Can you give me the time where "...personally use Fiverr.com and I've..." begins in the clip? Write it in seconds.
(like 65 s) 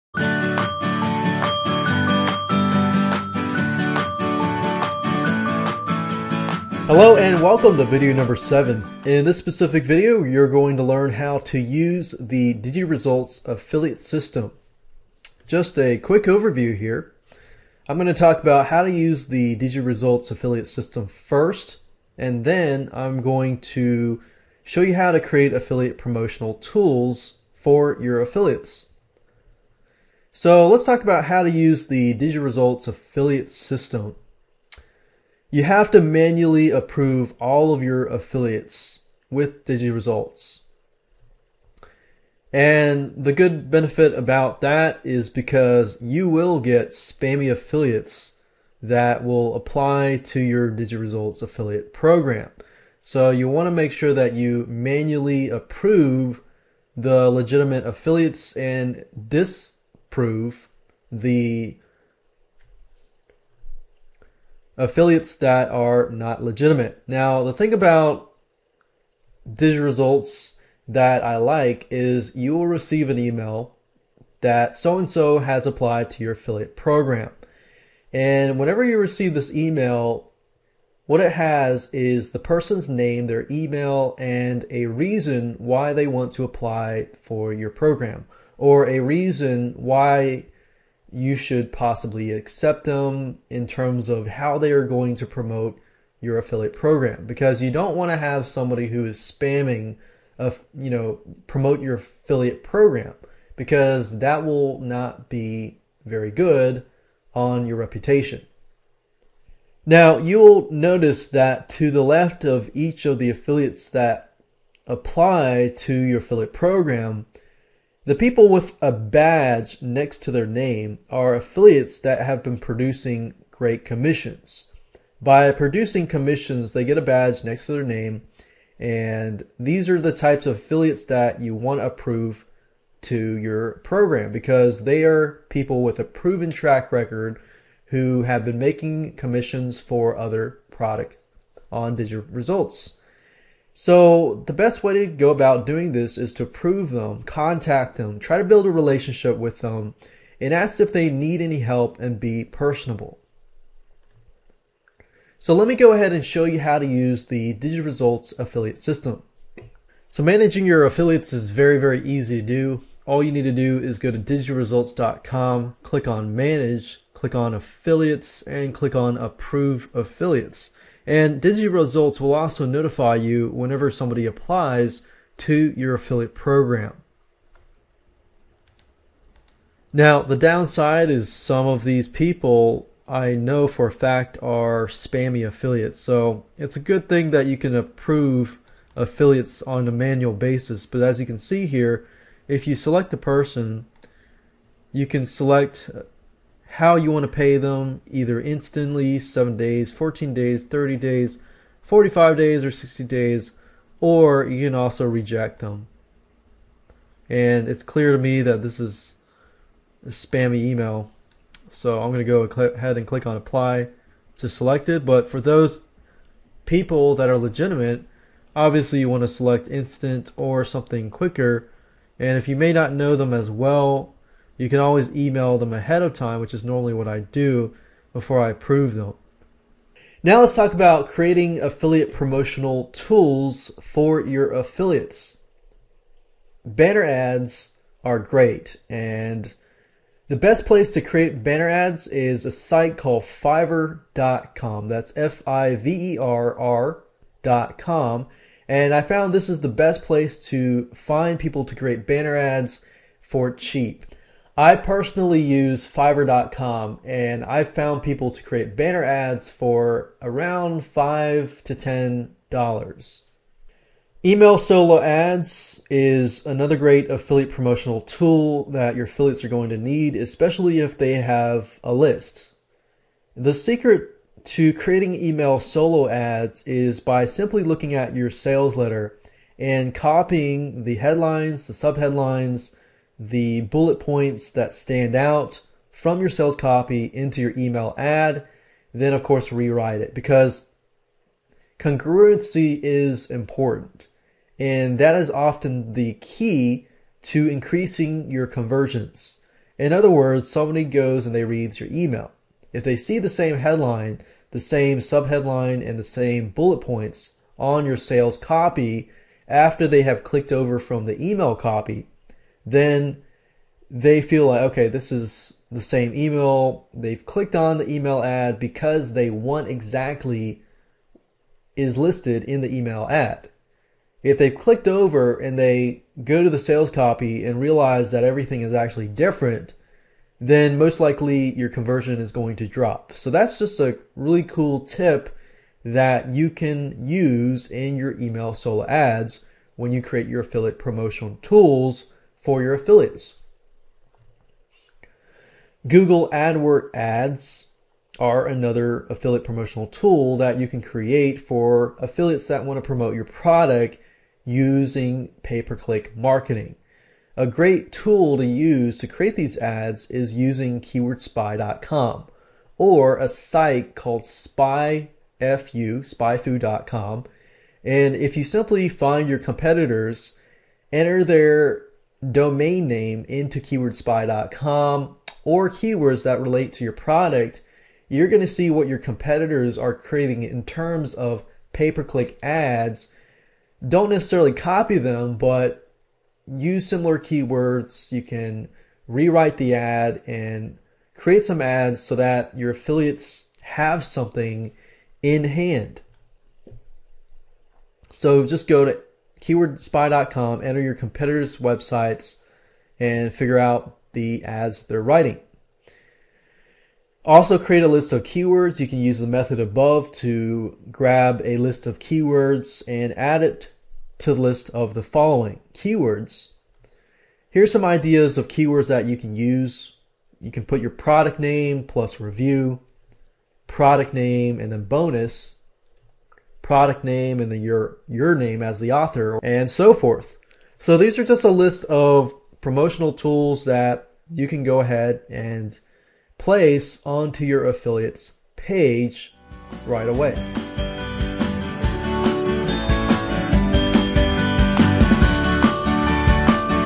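254 s.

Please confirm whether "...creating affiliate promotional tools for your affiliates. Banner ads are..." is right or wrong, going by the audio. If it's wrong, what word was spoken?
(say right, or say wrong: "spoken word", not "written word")
right.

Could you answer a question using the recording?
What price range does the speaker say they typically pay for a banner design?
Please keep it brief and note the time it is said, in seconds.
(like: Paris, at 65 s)
$5 to $10, at 260 s.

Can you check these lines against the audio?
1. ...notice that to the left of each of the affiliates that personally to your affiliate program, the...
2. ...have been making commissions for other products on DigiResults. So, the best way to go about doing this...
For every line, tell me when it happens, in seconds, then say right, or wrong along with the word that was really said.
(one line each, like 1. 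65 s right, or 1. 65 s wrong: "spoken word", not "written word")
1. 110 s wrong: "apply", not "personally"
2. 138 s right.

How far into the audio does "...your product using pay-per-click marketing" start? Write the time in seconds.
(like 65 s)
353 s.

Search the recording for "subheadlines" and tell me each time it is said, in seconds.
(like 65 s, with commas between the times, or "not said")
281 s, 304 s.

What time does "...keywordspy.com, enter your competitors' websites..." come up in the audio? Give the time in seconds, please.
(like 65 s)
399 s.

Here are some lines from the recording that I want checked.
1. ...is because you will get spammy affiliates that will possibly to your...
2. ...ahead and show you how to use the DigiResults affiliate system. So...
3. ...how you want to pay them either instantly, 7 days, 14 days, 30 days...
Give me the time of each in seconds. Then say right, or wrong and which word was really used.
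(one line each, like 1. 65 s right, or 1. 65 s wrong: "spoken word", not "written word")
1. 45 s wrong: "apply", not "possibly"
2. 155 s right
3. 196 s right.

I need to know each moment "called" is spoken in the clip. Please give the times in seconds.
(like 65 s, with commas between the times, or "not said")
242 s, 363 s.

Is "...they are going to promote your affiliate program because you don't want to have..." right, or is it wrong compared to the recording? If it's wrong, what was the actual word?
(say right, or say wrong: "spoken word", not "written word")
right.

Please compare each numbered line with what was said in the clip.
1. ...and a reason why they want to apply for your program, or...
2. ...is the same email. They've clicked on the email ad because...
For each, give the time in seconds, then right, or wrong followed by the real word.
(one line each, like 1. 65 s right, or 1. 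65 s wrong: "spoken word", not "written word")
1. 84 s right
2. 315 s right.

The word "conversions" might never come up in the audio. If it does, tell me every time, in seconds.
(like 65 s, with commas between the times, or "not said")
298 s, 331 s.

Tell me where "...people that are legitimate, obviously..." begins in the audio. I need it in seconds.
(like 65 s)
216 s.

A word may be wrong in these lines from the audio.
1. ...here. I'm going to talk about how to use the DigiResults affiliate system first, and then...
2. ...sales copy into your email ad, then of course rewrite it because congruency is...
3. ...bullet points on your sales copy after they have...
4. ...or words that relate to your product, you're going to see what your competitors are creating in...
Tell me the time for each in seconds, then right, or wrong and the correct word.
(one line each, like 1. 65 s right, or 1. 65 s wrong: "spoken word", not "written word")
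1. 16 s right
2. 286 s right
3. 306 s right
4. 375 s wrong: "keywords", not "words".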